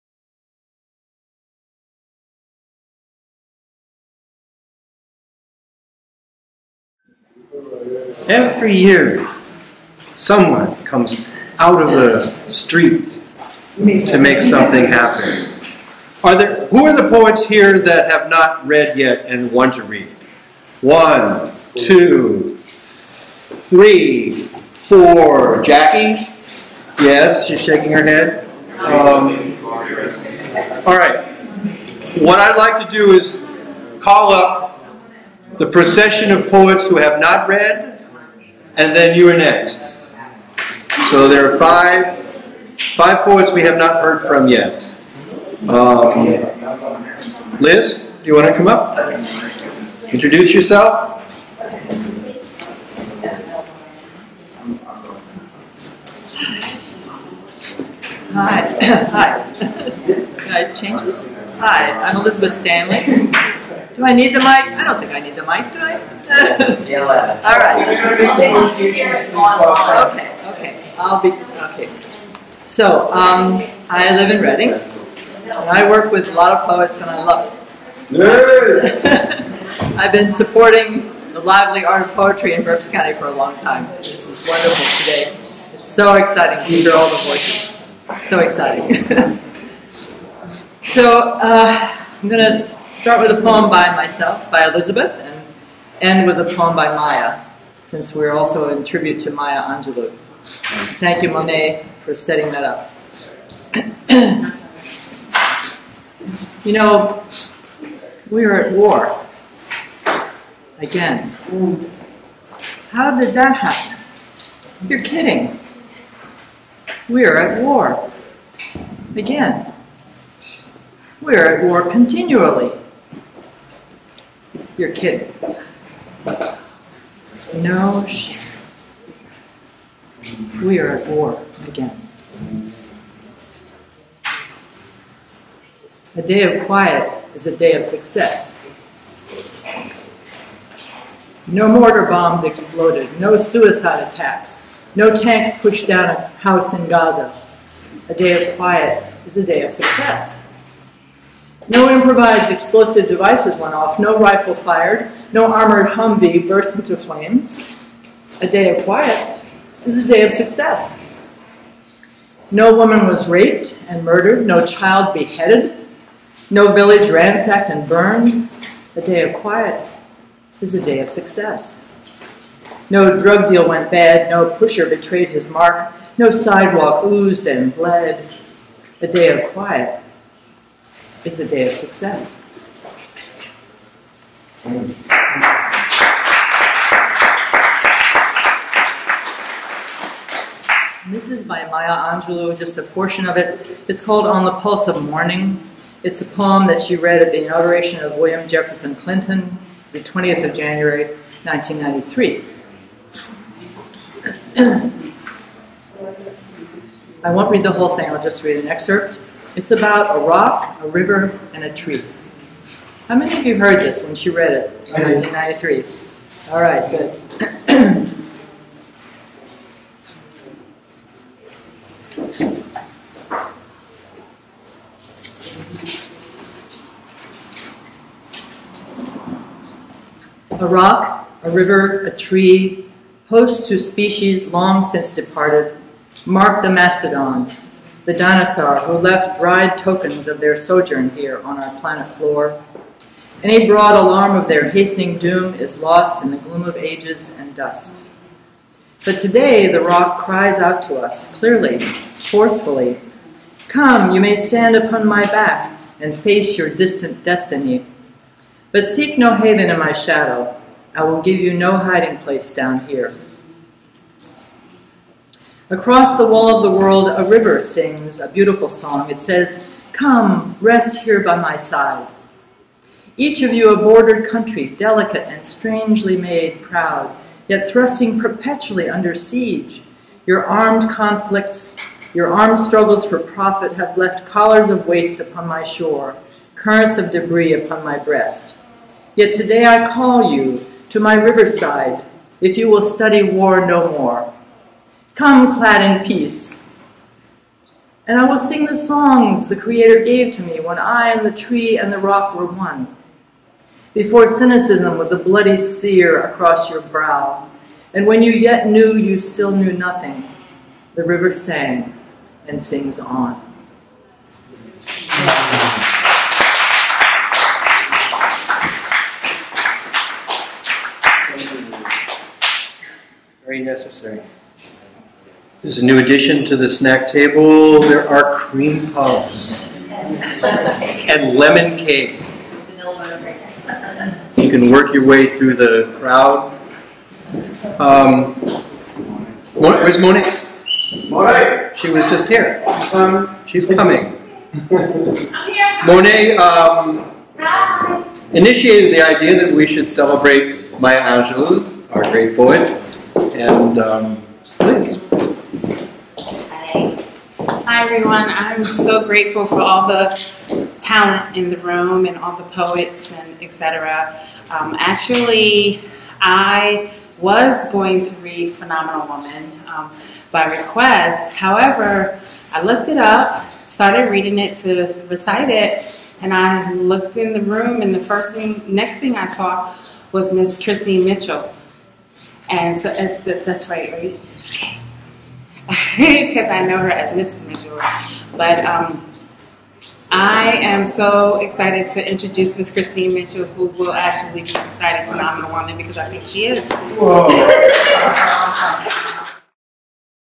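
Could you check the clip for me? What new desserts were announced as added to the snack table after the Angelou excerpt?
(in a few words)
cream puffs and lemon cake.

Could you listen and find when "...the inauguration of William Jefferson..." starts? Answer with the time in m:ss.
3:17.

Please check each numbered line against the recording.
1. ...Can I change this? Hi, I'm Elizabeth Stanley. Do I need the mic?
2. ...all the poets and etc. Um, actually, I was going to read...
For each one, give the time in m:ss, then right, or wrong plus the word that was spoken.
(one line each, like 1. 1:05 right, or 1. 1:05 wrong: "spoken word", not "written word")
1. 0:59 right
2. 6:02 right.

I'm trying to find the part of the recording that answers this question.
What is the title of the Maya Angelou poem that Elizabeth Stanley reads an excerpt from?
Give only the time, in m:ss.
3:14.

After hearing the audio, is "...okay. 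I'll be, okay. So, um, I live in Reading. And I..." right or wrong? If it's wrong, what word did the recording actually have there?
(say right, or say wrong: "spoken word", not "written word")
right.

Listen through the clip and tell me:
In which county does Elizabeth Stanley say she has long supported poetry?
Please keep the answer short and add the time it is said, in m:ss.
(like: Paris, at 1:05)
Berks County, at 1:22.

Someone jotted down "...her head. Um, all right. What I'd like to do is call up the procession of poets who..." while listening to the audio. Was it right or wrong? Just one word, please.
right.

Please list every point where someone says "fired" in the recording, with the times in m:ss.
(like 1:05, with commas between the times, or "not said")
2:34.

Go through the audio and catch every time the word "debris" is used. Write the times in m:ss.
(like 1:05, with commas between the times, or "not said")
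4:47.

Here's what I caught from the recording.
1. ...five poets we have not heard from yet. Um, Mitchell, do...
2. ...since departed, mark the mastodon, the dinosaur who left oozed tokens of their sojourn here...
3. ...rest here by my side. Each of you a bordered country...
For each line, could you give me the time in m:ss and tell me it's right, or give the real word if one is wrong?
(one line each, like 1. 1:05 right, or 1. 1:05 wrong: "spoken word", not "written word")
1. 0:42 wrong: "Liz", not "Mitchell"
2. 3:54 wrong: "dried", not "oozed"
3. 4:30 right.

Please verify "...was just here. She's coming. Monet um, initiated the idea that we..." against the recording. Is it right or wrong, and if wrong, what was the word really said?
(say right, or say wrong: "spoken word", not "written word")
right.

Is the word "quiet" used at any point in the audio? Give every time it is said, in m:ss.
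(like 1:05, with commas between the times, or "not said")
2:16, 2:28, 2:38, 2:49, 2:59.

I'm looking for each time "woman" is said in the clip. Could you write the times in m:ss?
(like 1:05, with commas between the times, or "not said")
2:42, 6:09, 6:35.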